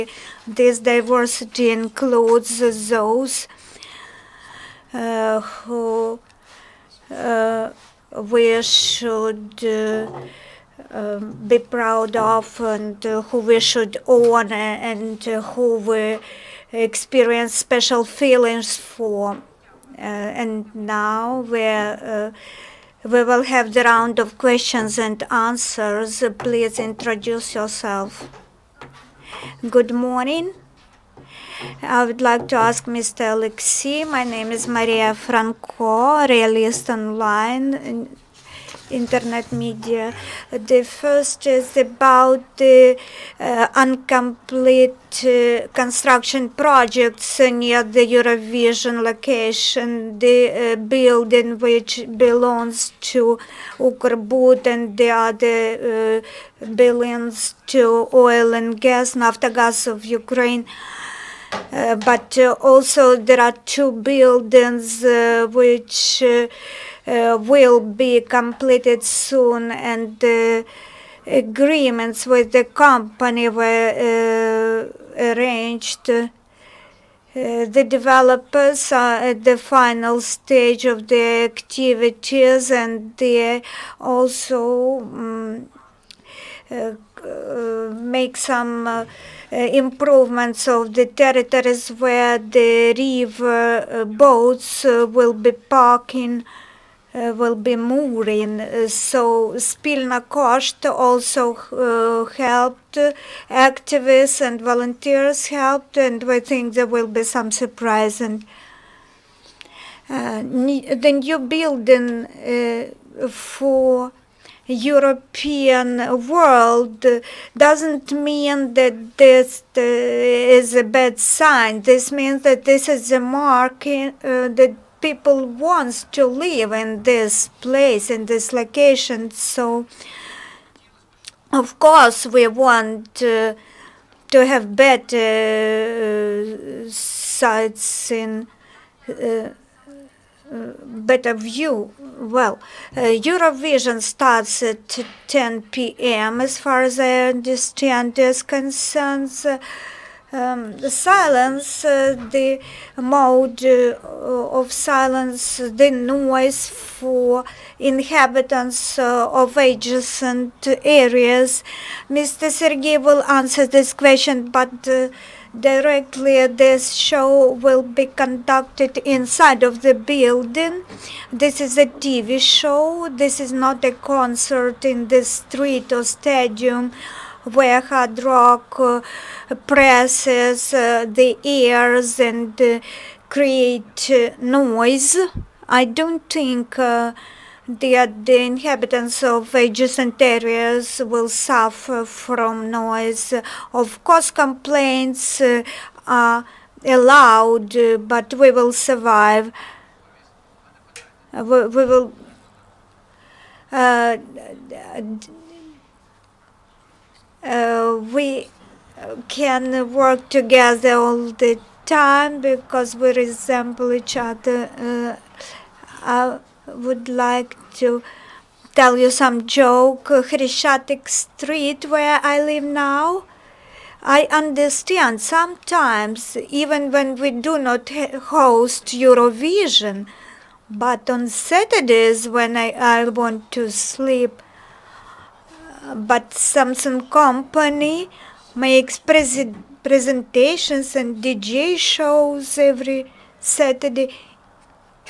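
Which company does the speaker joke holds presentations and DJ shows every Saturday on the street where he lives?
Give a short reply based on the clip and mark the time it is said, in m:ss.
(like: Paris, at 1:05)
Samsung, at 3:56.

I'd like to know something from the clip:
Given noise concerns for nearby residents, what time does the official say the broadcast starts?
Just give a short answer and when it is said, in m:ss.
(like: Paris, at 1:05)
10 p.m., at 2:25.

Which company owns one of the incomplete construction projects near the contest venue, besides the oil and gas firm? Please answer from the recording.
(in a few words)
Ukrbud.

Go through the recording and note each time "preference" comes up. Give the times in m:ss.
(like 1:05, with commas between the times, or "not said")
not said.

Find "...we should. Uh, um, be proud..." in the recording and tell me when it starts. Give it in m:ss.
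0:08.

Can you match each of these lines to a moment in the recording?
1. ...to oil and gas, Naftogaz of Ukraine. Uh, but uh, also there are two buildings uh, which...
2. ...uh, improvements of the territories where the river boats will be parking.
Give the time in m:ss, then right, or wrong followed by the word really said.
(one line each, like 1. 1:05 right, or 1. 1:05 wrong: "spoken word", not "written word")
1. 0:57 right
2. 1:28 right.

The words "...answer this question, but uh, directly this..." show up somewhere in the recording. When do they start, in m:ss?
2:43.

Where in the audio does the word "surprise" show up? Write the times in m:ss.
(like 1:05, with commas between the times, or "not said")
1:47.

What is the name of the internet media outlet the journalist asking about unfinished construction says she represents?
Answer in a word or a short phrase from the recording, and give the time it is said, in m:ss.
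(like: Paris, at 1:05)
realist online, at 0:36.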